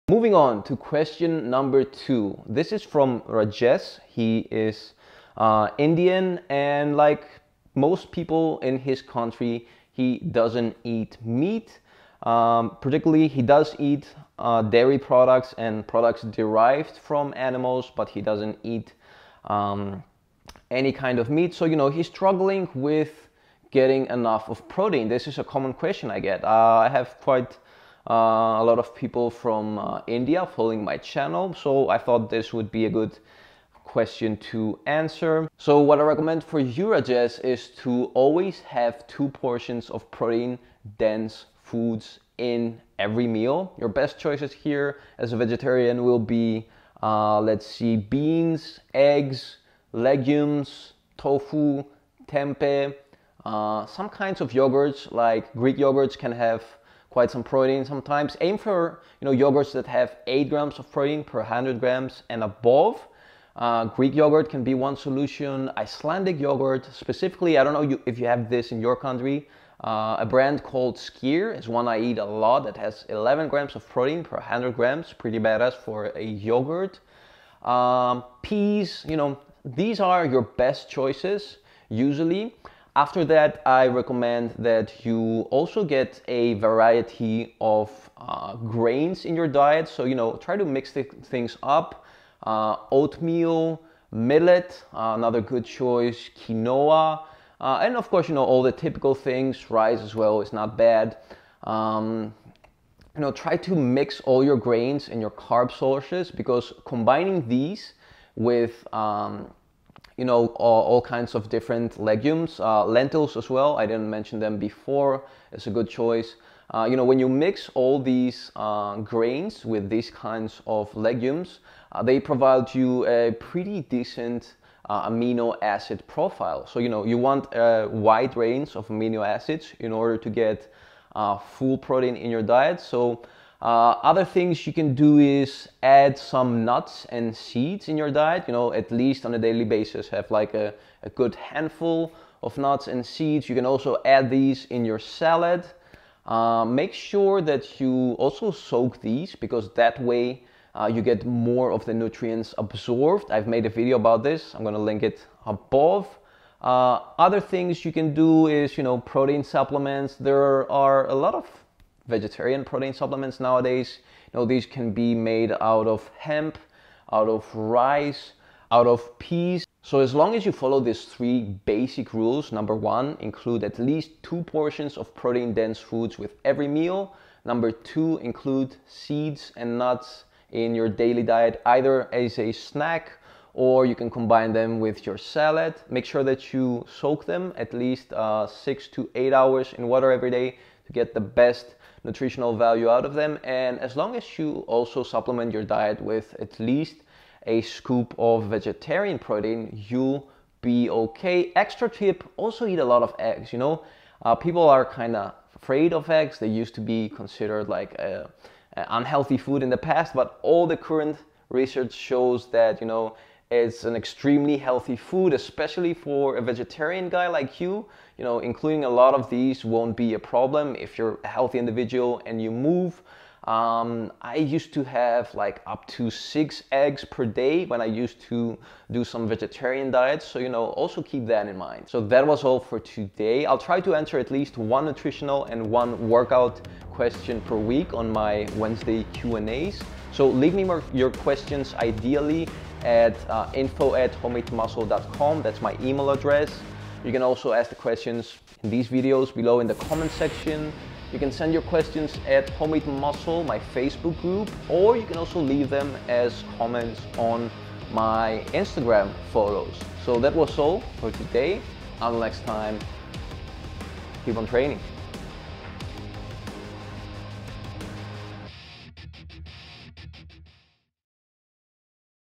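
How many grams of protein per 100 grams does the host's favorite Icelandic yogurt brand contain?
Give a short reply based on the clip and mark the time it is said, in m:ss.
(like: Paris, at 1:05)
11 grams, at 1:13.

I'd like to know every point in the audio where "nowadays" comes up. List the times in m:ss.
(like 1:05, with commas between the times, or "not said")
2:43.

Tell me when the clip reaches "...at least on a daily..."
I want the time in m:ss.
2:18.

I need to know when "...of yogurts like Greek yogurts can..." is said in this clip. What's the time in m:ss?
0:54.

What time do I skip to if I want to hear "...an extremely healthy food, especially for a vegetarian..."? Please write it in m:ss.
3:33.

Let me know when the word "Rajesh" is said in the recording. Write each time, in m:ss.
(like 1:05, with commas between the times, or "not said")
0:03, 0:36.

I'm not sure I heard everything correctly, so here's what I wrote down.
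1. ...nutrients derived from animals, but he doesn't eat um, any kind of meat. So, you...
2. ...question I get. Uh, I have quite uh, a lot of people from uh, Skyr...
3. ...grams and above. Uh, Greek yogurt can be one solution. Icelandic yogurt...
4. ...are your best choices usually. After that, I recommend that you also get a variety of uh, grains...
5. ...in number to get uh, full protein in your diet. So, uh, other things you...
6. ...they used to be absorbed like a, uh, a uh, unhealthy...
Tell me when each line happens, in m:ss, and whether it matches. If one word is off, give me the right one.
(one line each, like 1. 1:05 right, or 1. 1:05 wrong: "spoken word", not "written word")
1. 0:15 wrong: "products", not "nutrients"
2. 0:25 wrong: "India", not "Skyr"
3. 1:01 right
4. 1:19 right
5. 2:09 wrong: "order", not "number"
6. 3:26 wrong: "considered", not "absorbed".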